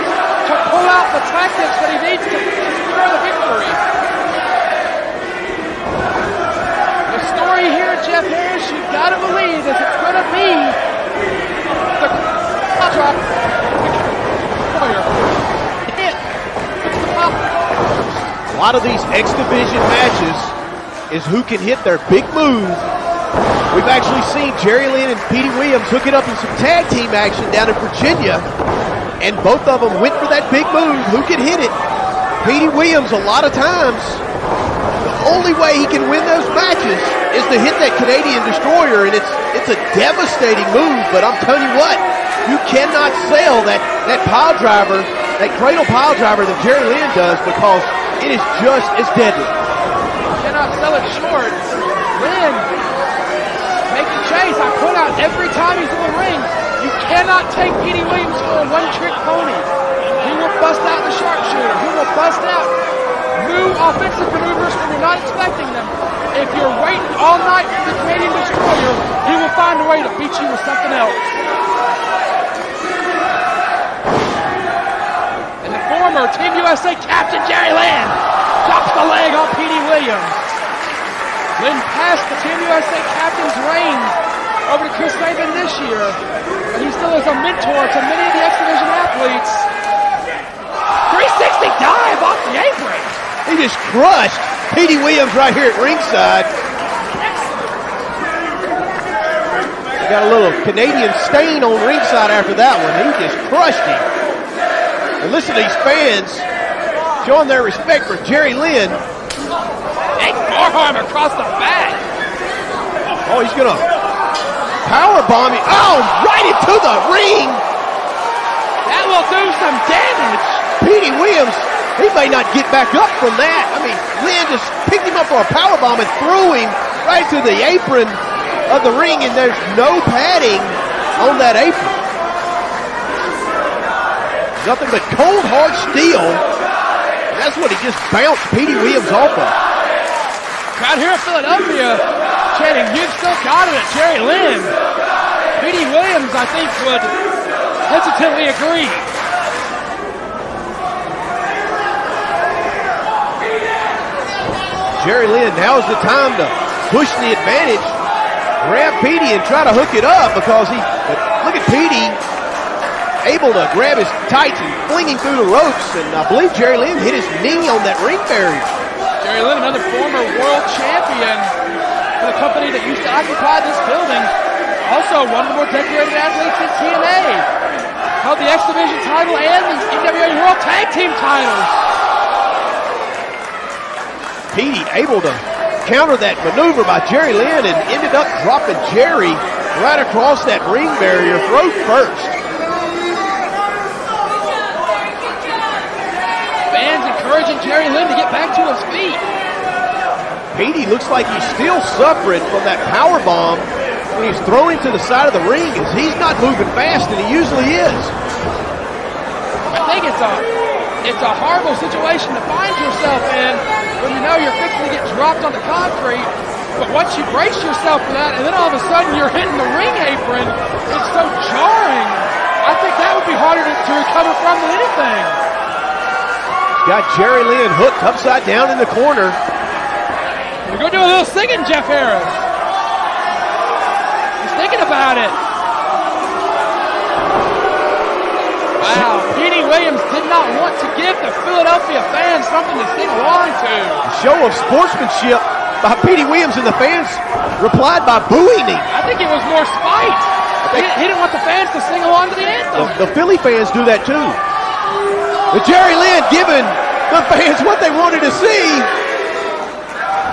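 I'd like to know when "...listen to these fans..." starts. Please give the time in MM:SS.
01:45.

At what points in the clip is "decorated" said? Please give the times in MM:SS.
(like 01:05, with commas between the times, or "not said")
02:55.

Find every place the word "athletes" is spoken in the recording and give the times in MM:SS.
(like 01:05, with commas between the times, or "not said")
01:28, 02:56.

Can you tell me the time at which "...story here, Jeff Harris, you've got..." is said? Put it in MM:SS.
00:07.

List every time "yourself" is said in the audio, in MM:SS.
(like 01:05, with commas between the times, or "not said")
03:32, 03:37.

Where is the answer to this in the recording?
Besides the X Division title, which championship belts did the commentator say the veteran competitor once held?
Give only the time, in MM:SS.
02:59.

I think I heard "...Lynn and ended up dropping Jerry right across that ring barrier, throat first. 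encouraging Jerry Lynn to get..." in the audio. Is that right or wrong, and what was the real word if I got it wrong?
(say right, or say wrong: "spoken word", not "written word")
right.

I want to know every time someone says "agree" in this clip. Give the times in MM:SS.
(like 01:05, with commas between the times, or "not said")
02:28.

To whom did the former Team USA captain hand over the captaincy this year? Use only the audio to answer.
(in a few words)
Chris Sabin.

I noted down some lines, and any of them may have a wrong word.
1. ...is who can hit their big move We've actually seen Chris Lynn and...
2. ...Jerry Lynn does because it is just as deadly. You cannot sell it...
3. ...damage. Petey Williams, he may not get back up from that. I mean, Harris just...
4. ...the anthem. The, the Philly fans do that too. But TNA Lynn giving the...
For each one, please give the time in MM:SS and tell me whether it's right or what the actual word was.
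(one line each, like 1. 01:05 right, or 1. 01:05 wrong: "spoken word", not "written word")
1. 00:21 wrong: "Jerry", not "Chris"
2. 00:46 right
3. 01:59 wrong: "Lynn", not "Harris"
4. 04:12 wrong: "Jerry", not "TNA".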